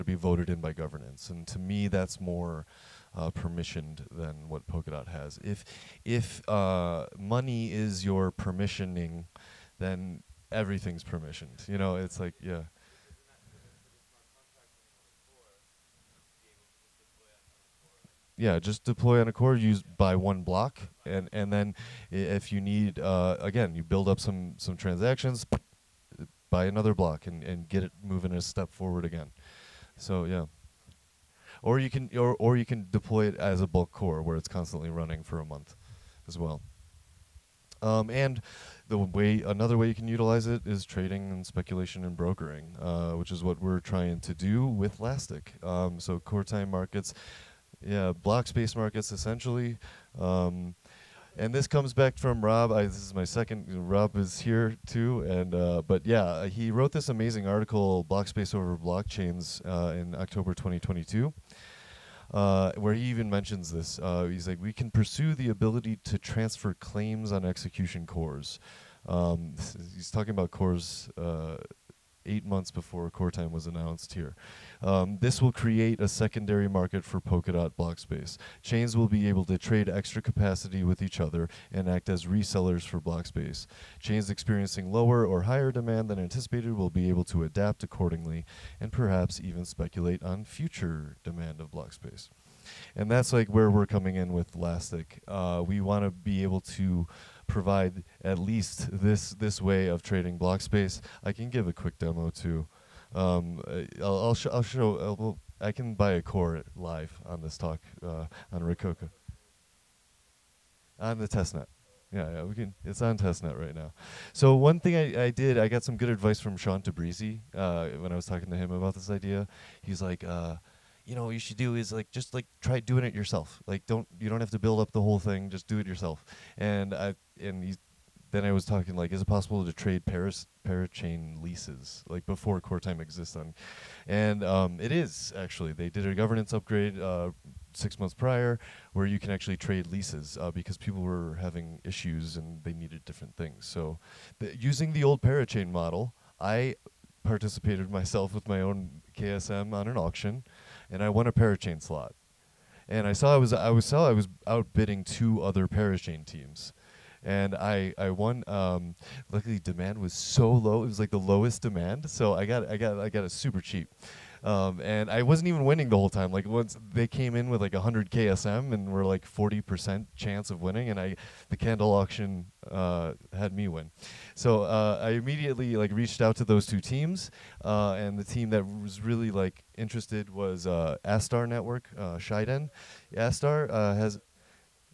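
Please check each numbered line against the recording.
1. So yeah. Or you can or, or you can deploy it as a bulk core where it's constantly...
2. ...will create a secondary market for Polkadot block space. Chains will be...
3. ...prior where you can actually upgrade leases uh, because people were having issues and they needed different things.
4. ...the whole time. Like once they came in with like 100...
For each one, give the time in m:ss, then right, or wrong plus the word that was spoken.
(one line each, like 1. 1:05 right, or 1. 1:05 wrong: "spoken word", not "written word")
1. 0:29 right
2. 1:15 right
3. 2:18 wrong: "trade", not "upgrade"
4. 2:45 right.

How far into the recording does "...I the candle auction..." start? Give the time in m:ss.
2:50.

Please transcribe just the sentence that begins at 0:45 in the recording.
Um, so core time markets yeah, block space markets essentially.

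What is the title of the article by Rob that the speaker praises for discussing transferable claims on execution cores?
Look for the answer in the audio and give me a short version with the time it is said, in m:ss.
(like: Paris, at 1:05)
Block Space Over Blockchains, at 0:58.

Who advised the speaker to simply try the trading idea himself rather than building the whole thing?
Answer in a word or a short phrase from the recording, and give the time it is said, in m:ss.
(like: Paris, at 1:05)
Shawn Tabrizi, at 1:56.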